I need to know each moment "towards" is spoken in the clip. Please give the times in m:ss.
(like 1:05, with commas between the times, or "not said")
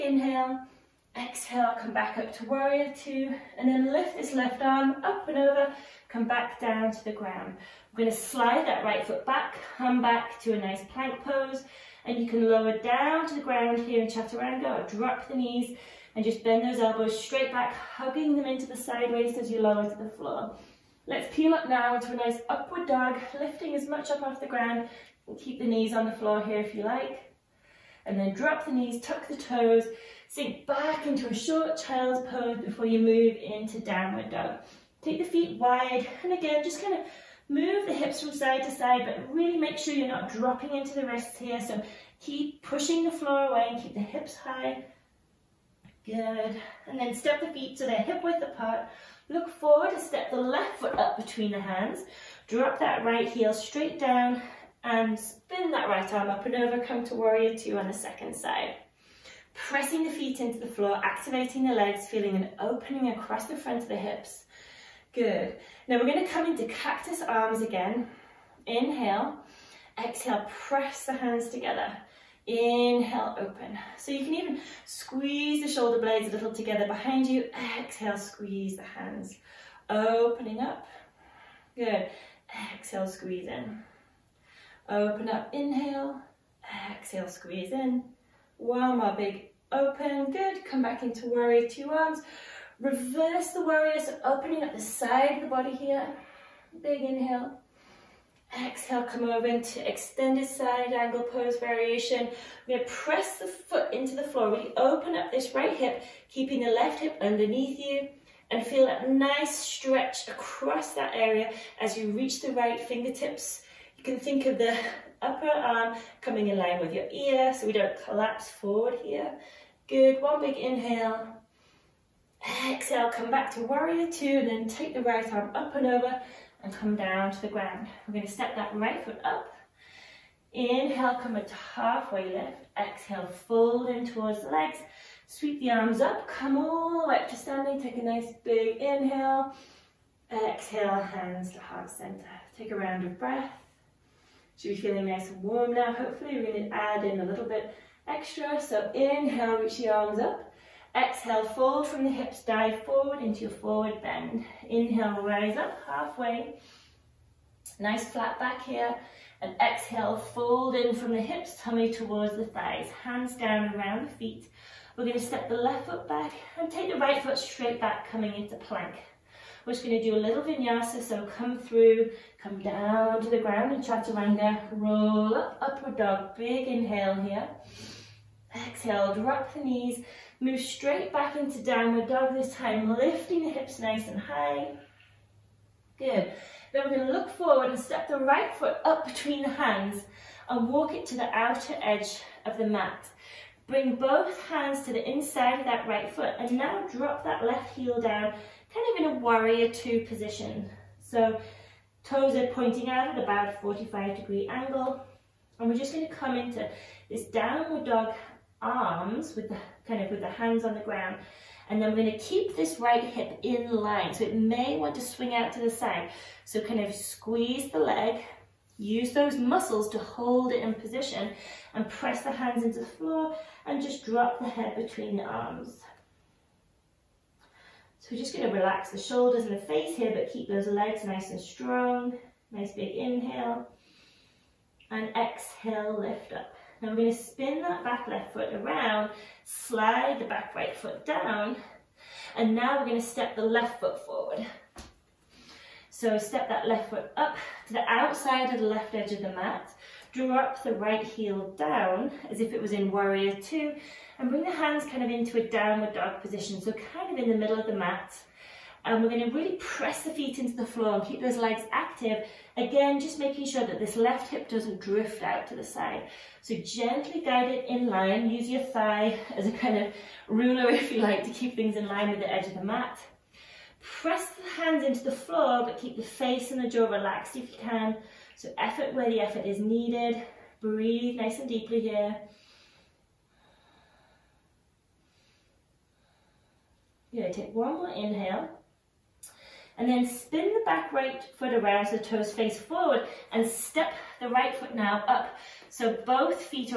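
2:14, 2:41.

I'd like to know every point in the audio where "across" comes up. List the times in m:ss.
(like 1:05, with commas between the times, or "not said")
1:03, 1:50.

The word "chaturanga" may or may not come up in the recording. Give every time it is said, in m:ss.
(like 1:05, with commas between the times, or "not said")
0:14, 2:53.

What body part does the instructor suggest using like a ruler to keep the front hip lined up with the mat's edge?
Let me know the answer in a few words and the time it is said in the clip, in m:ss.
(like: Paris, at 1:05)
Thigh, at 4:28.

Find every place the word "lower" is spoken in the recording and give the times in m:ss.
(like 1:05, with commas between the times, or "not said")
0:12, 0:19.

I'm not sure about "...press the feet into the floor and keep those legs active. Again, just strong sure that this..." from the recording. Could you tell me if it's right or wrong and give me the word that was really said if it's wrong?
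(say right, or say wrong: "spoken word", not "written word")
wrong: "making", not "strong".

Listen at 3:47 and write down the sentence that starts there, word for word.
So we're just going to relax the shoulders and the face here, but keep those legs nice and strong.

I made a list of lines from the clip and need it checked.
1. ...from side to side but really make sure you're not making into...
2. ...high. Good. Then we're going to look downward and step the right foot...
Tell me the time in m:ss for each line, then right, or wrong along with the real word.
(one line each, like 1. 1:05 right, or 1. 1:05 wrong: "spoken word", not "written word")
1. 0:38 wrong: "dropping", not "making"
2. 3:04 wrong: "forward", not "downward".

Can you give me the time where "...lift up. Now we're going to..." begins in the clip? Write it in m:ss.
3:55.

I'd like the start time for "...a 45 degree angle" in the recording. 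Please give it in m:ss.
3:23.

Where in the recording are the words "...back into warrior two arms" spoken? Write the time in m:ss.
1:30.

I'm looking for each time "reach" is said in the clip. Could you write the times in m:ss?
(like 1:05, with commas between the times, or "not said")
1:52, 2:29.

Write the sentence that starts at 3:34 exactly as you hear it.
So it may want to swing out to the side.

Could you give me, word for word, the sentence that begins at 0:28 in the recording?
And then drop the knees, tuck the toes, Sink back into a short child's pose before you move into downward dog.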